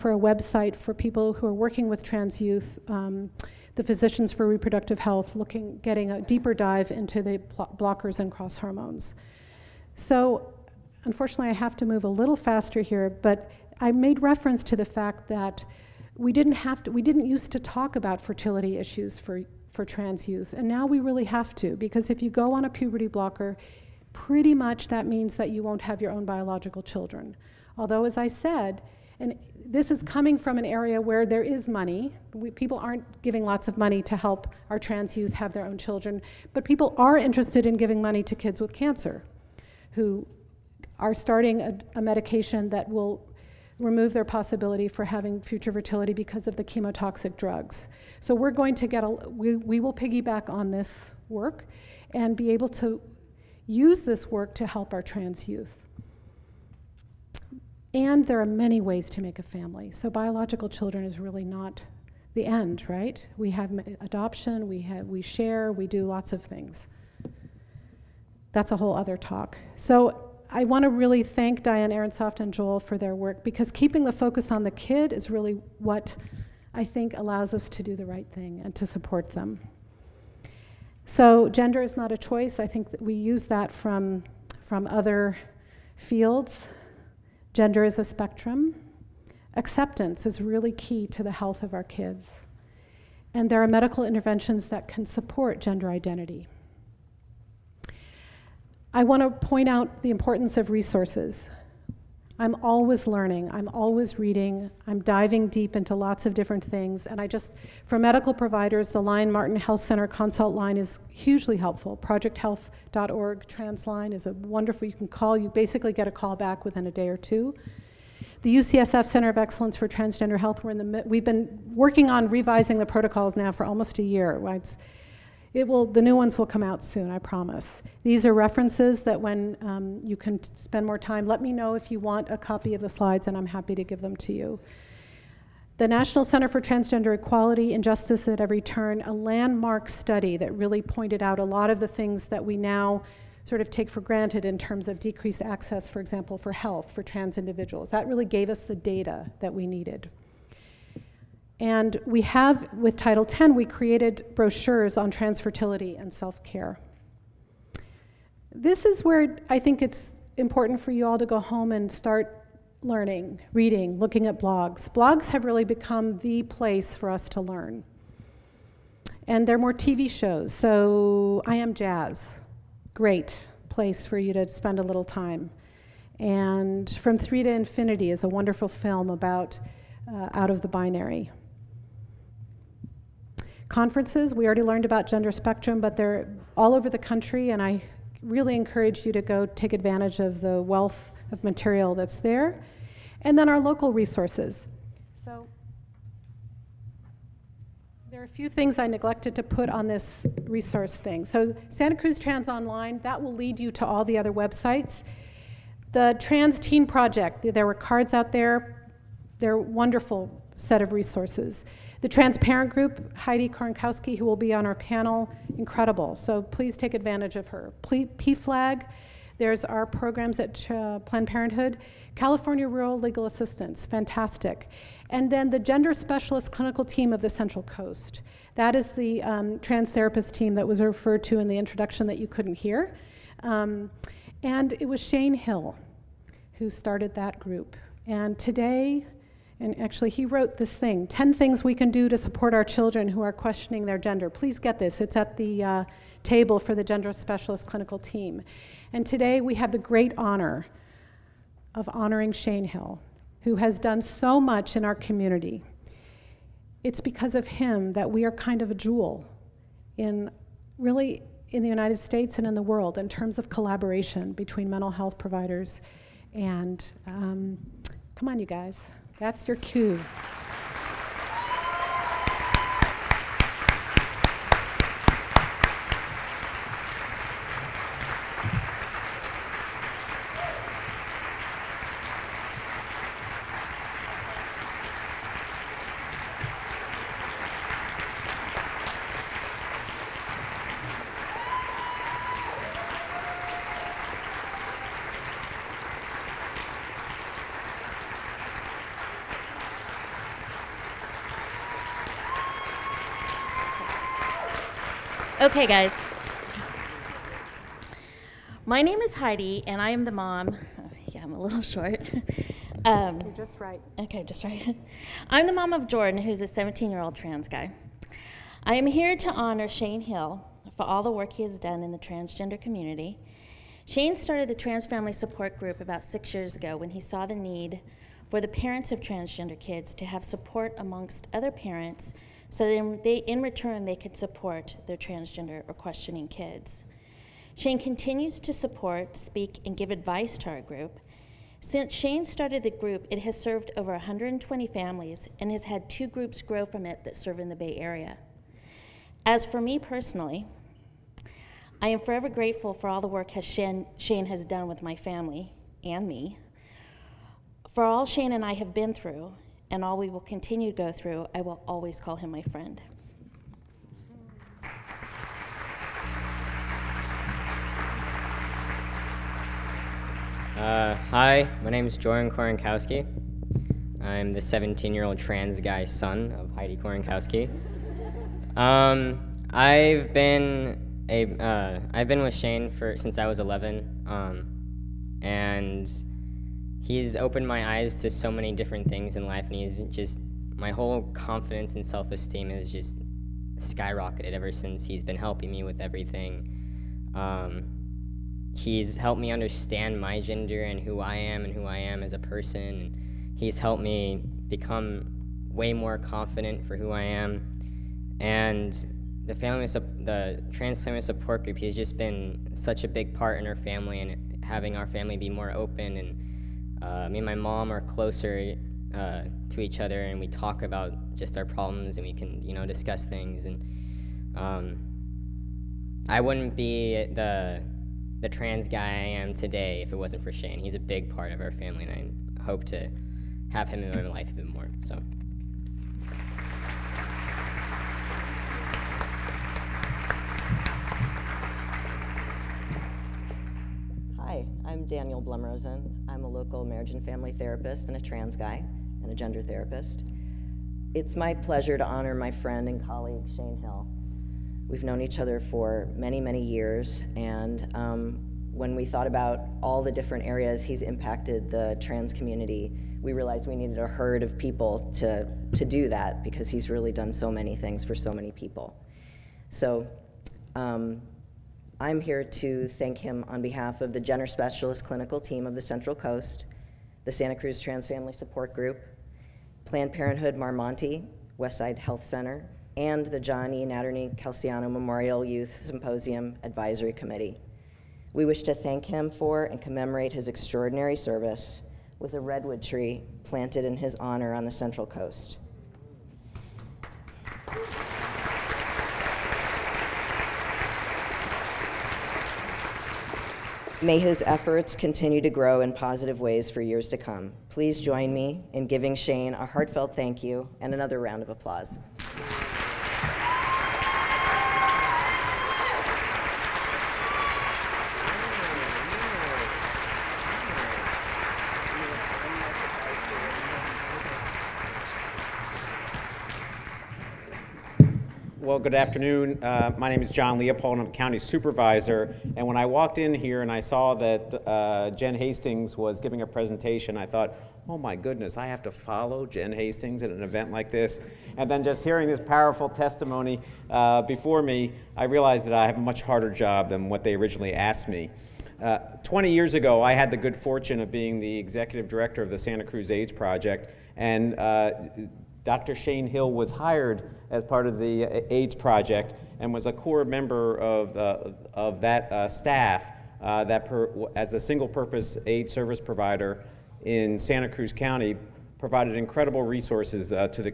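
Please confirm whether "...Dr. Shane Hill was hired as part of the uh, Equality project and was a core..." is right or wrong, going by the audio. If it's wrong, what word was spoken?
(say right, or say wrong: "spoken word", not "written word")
wrong: "AIDS", not "Equality".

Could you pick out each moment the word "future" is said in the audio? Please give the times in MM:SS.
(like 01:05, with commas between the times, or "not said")
00:45.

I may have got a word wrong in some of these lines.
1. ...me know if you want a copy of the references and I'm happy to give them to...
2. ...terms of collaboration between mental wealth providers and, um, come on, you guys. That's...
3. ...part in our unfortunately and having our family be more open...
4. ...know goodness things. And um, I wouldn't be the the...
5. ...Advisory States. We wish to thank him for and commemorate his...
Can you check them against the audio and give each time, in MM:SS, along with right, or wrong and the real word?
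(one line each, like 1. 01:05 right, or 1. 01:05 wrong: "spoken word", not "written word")
1. 02:11 wrong: "slides", not "references"
2. 04:23 wrong: "health", not "wealth"
3. 06:53 wrong: "family", not "unfortunately"
4. 07:02 wrong: "discuss", not "goodness"
5. 08:06 wrong: "Committee", not "States".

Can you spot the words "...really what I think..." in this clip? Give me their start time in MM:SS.
01:15.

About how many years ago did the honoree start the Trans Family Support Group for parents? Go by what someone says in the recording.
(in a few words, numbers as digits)
6.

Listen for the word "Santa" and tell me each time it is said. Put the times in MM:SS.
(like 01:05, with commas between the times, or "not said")
03:21, 07:57, 09:12, 09:27.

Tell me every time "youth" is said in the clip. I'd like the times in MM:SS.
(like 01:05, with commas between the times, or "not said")
00:02, 00:20, 00:35, 00:55, 08:05.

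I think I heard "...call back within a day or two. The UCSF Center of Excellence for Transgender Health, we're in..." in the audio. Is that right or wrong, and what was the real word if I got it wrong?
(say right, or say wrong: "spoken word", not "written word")
right.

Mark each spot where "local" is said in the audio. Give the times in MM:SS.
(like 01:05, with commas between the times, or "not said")
03:13, 07:26.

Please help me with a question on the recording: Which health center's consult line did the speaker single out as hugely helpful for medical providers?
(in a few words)
Lyon-Martin Health Center.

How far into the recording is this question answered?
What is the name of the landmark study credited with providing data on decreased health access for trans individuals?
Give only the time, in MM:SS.
02:17.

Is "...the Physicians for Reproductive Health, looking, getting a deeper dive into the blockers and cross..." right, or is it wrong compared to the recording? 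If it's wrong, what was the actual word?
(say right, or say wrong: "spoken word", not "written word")
right.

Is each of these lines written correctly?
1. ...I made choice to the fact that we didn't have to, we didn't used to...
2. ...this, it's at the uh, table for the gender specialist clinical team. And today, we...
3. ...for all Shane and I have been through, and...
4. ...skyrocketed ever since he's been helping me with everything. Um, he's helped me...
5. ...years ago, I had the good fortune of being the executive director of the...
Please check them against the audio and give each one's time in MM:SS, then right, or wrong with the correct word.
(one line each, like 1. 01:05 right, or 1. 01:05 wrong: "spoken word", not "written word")
1. 00:13 wrong: "reference", not "choice"
2. 04:04 right
3. 05:57 right
4. 06:33 right
5. 09:09 right.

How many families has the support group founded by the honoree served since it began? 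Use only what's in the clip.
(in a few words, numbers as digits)
over 120.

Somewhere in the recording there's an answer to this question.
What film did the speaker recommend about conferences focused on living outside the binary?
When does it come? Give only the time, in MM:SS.
02:56.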